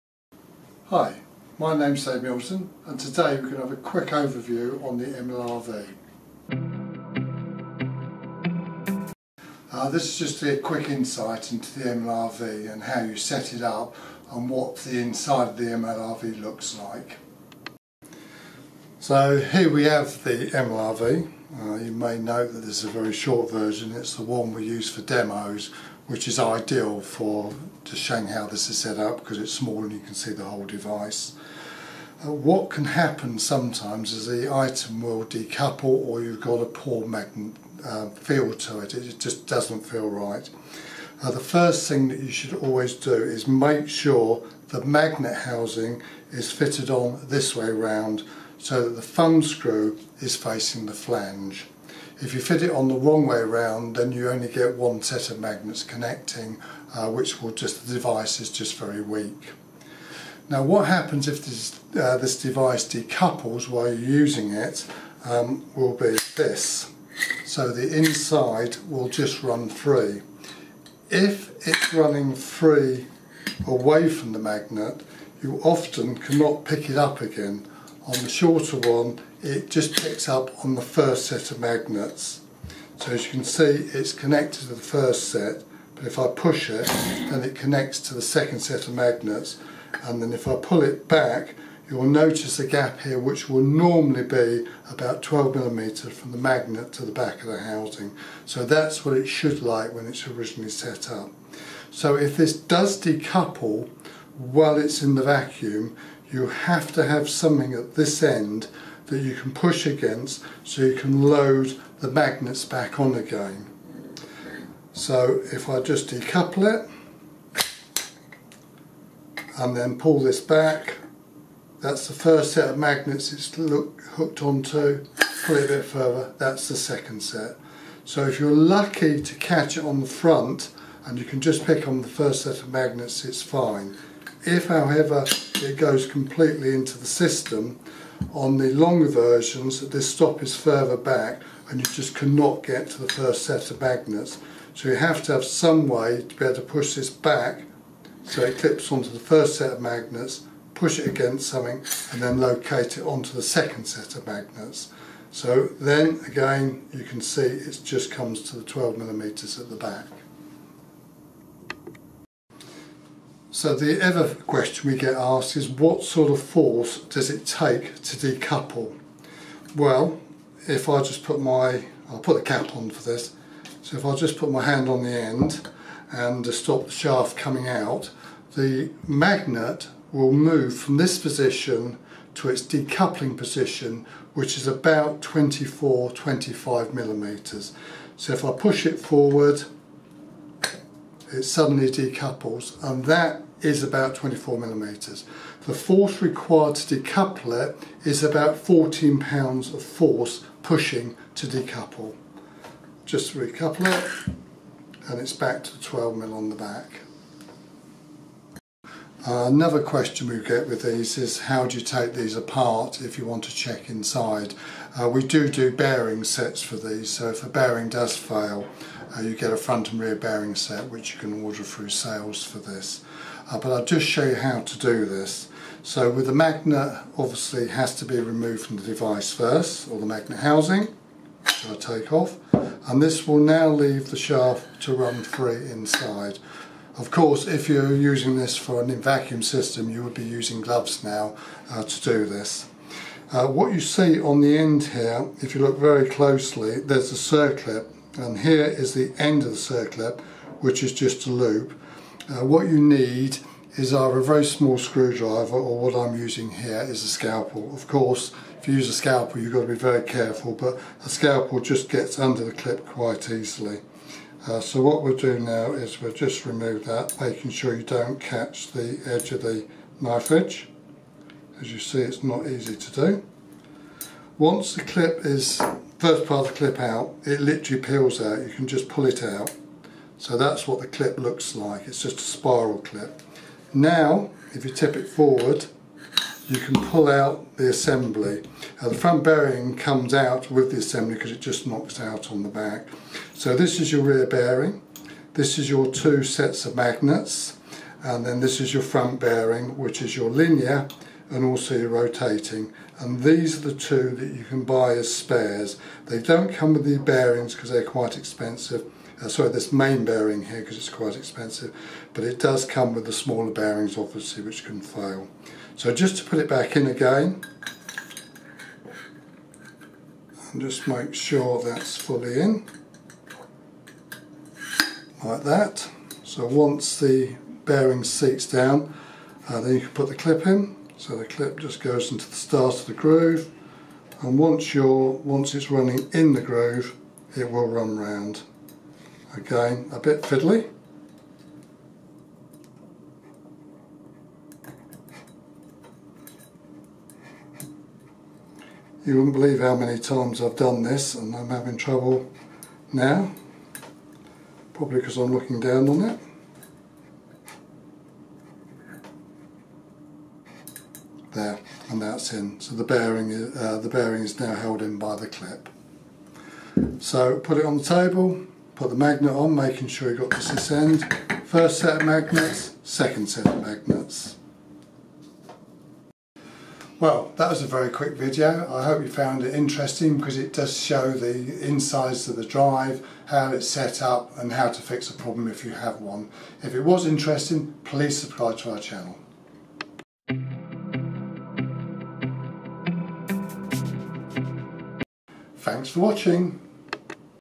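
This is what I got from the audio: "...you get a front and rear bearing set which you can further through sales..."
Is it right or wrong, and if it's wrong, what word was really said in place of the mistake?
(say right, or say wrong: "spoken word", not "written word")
wrong: "order", not "further".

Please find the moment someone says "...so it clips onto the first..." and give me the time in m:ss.
2:28.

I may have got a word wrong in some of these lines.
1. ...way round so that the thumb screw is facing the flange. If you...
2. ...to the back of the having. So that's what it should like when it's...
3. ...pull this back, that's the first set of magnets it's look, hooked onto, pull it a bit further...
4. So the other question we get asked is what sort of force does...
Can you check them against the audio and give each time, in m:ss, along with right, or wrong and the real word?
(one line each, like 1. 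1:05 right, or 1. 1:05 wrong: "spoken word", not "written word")
1. 0:47 right
2. 1:36 wrong: "housing", not "having"
3. 1:59 right
4. 2:43 right.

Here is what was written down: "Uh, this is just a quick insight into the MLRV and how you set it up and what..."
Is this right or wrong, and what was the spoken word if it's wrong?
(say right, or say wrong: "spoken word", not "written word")
right.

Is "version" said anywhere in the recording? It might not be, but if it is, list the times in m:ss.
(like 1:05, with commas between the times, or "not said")
0:23, 2:19.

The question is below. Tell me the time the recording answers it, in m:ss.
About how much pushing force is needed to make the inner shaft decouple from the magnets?
3:18.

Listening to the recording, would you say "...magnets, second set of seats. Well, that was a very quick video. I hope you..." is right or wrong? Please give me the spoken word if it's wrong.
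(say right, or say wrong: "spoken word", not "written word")
wrong: "magnets", not "seats".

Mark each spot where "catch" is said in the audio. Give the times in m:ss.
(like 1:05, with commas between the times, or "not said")
2:09, 4:28.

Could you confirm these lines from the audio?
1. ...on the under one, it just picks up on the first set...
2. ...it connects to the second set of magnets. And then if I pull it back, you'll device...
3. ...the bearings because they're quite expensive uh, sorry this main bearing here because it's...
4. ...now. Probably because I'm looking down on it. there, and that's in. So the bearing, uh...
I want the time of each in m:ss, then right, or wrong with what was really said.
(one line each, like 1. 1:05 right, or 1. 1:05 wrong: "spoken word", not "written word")
1. 1:18 wrong: "shorter", not "under"
2. 1:27 wrong: "notice", not "device"
3. 5:06 right
4. 5:52 right.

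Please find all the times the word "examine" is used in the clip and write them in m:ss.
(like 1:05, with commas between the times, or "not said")
not said.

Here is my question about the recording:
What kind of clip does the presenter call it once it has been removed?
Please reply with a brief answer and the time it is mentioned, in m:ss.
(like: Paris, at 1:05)
spiral clip, at 4:42.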